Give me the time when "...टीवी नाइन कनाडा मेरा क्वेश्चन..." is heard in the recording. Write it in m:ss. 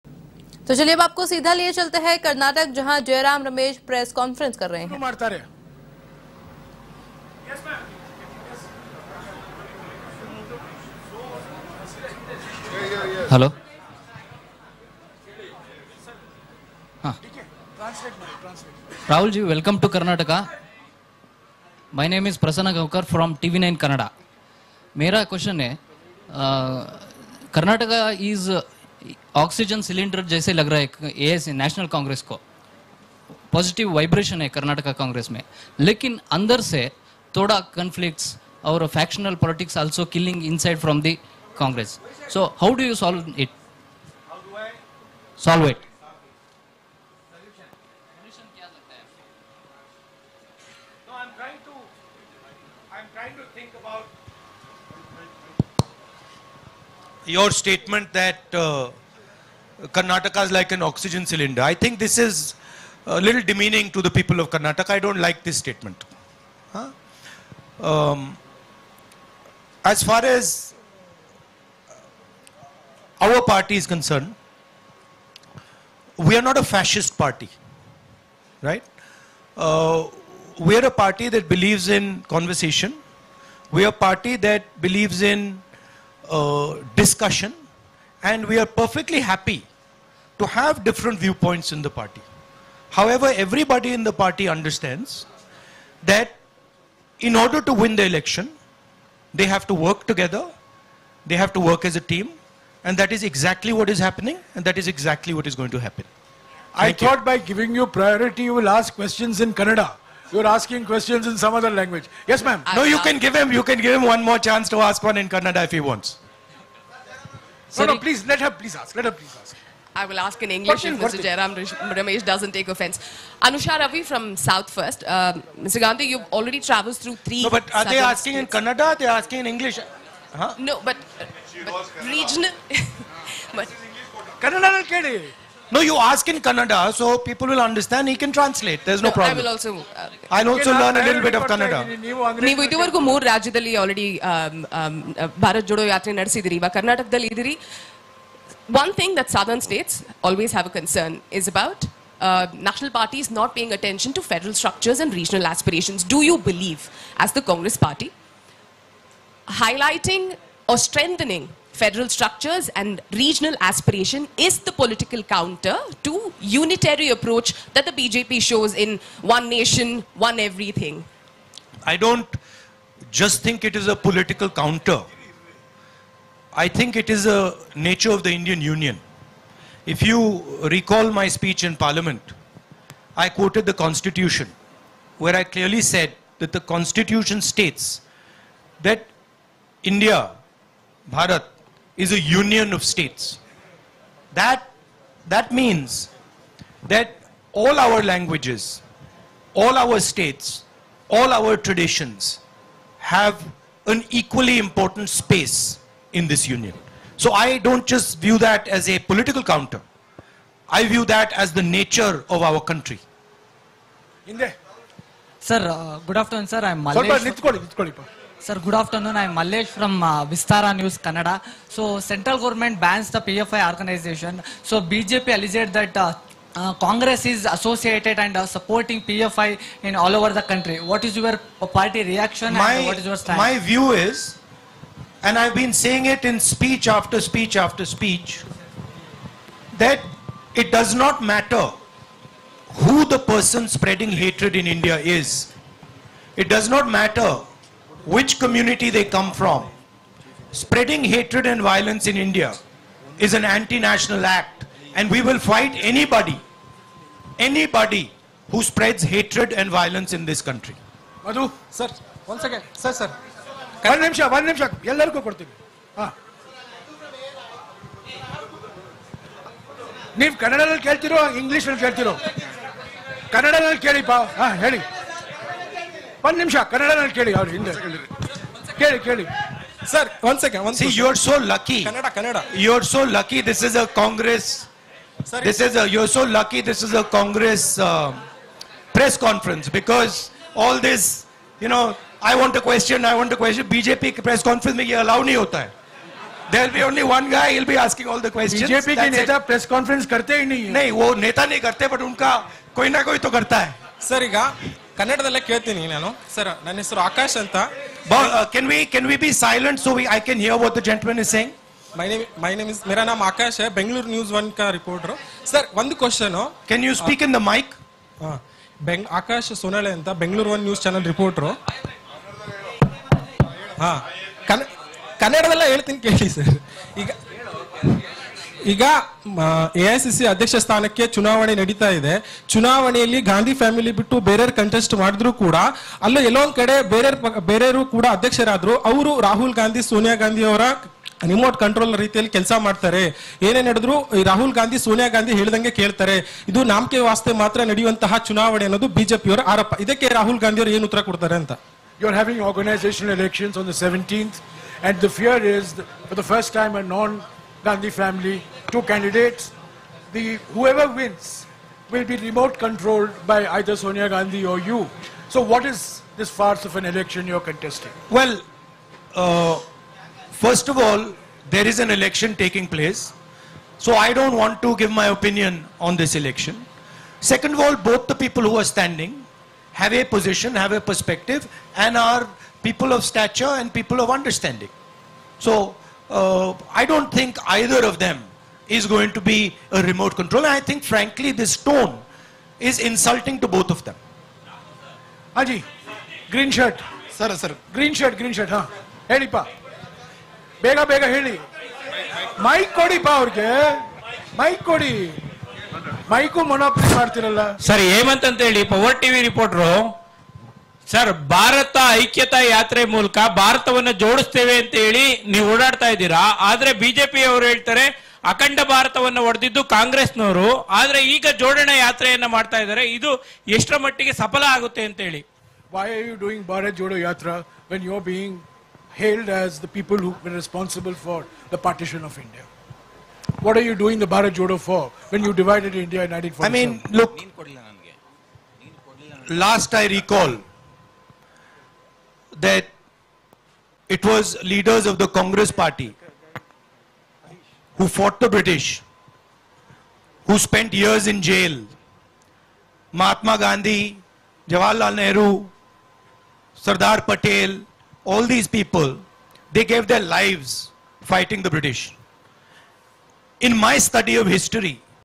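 0:23.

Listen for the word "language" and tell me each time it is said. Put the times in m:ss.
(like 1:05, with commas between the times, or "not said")
1:51, 3:18.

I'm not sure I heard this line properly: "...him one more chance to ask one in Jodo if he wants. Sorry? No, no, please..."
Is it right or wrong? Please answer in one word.
wrong.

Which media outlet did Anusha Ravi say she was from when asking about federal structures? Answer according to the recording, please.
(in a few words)
South First.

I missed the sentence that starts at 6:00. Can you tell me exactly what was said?
The whoever wins will be remote controlled by either Sonia Gandhi or you.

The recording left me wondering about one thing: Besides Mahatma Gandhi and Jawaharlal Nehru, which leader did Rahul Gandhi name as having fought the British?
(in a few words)
Sardar Patel.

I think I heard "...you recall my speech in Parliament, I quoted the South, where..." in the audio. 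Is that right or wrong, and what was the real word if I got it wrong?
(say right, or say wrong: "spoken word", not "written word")
wrong: "Constitution", not "South".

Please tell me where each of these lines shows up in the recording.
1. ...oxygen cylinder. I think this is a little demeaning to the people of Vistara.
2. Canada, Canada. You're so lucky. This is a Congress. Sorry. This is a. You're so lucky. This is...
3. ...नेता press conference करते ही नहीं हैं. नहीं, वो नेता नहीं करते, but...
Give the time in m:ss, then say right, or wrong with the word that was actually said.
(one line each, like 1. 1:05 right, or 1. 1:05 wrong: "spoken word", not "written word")
1. 1:00 wrong: "Karnataka", not "Vistara"
2. 4:41 right
3. 4:59 right.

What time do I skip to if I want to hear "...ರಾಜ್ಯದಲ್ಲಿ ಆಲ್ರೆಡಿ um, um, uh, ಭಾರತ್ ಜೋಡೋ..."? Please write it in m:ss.
2:23.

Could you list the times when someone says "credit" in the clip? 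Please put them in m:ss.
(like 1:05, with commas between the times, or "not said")
not said.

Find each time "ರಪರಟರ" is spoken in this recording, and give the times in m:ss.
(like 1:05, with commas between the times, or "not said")
5:14, 5:21, 6:49.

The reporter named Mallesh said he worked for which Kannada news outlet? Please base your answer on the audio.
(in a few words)
Vistara News Kannada.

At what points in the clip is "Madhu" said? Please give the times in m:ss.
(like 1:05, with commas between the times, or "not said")
4:21.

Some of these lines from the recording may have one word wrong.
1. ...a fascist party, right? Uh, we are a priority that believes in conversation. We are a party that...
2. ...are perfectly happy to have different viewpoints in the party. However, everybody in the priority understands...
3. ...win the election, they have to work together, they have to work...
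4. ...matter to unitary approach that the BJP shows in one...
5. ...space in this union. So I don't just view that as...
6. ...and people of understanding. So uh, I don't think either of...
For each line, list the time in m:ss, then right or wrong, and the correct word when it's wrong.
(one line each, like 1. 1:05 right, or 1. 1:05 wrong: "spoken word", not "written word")
1. 1:16 wrong: "party", not "priority"
2. 1:28 wrong: "party", not "priority"
3. 1:37 right
4. 2:45 wrong: "counter", not "matter"
5. 3:25 right
6. 6:23 right.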